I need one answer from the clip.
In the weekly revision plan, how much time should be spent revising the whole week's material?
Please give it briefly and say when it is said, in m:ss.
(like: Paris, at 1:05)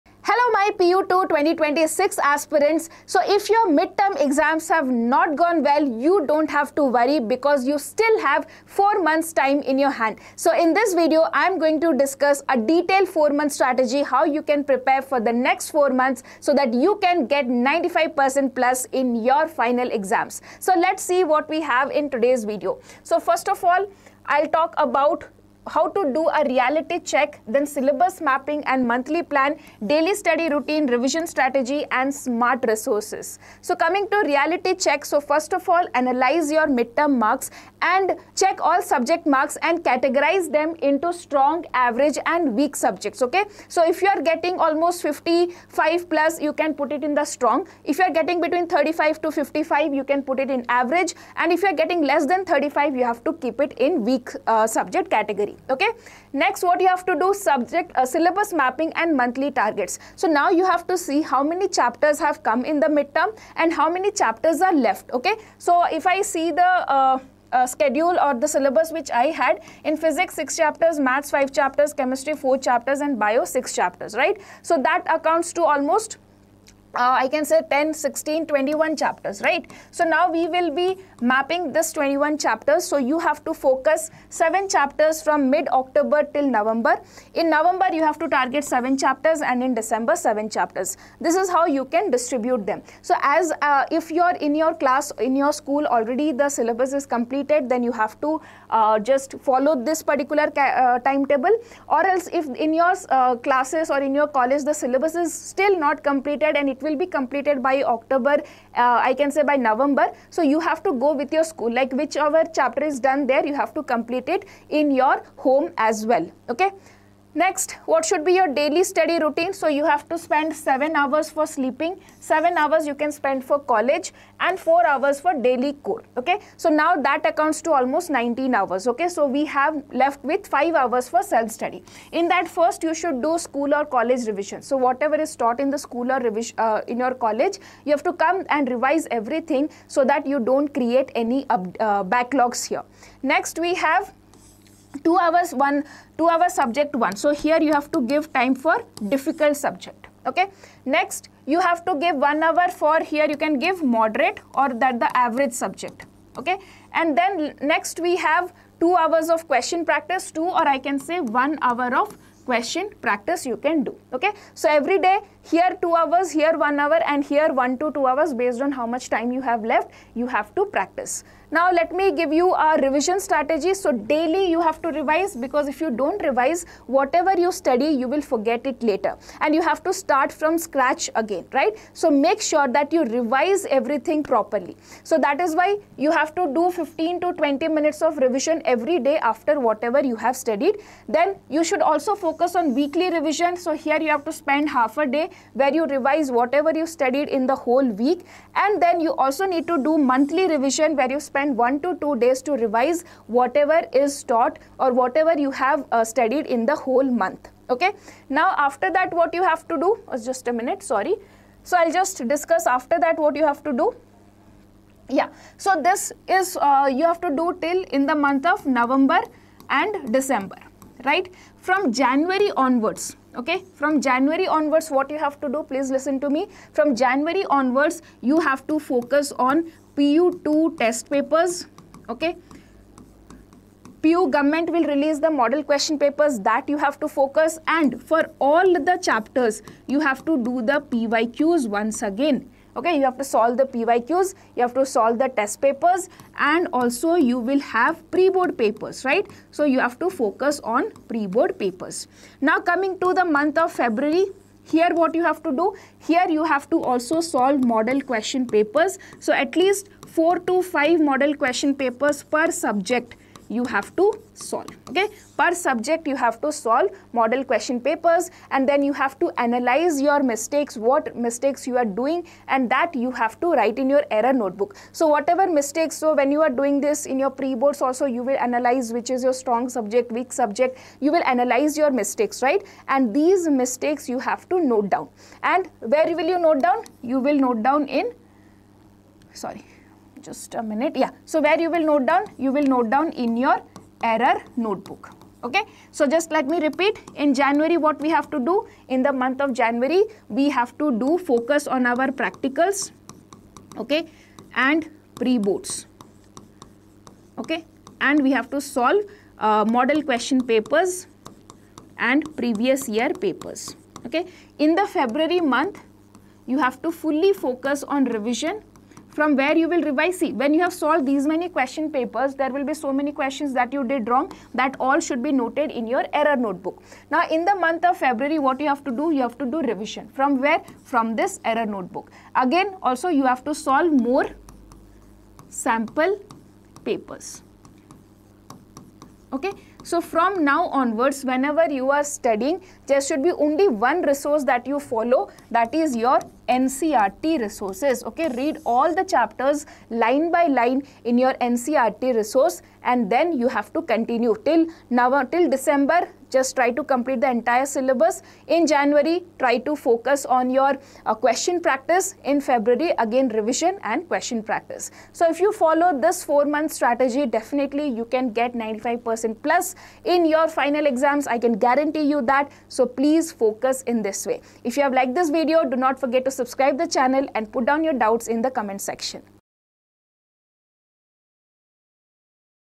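Half a day, at 3:14.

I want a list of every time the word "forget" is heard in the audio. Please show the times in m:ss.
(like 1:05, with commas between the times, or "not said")
2:58, 6:15.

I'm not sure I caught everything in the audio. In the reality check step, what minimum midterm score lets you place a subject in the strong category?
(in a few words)
55+.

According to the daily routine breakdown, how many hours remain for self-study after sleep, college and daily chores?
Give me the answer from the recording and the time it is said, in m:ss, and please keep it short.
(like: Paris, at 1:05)
5 hours, at 2:10.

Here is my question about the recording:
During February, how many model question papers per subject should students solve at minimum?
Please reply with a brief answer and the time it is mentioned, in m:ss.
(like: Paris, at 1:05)
4 to 5, at 4:20.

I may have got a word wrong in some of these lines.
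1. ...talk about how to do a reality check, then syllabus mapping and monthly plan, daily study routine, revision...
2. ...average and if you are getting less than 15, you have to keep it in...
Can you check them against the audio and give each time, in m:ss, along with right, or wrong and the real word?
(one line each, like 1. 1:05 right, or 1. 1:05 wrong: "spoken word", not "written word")
1. 0:24 right
2. 0:50 wrong: "35", not "15".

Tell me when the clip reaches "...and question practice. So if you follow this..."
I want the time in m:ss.
6:03.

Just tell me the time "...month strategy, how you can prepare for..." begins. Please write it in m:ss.
0:13.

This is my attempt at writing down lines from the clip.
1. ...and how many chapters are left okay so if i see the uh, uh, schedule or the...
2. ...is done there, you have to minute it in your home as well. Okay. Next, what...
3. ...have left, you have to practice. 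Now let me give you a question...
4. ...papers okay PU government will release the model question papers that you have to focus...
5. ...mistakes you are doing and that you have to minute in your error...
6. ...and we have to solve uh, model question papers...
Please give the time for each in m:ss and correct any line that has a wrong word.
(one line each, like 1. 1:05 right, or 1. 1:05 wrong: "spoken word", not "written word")
1. 1:03 right
2. 1:52 wrong: "complete", not "minute"
3. 2:49 wrong: "revision", not "question"
4. 3:51 right
5. 4:31 wrong: "write", not "minute"
6. 5:08 right.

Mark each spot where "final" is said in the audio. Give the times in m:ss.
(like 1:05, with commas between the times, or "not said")
0:19, 6:10.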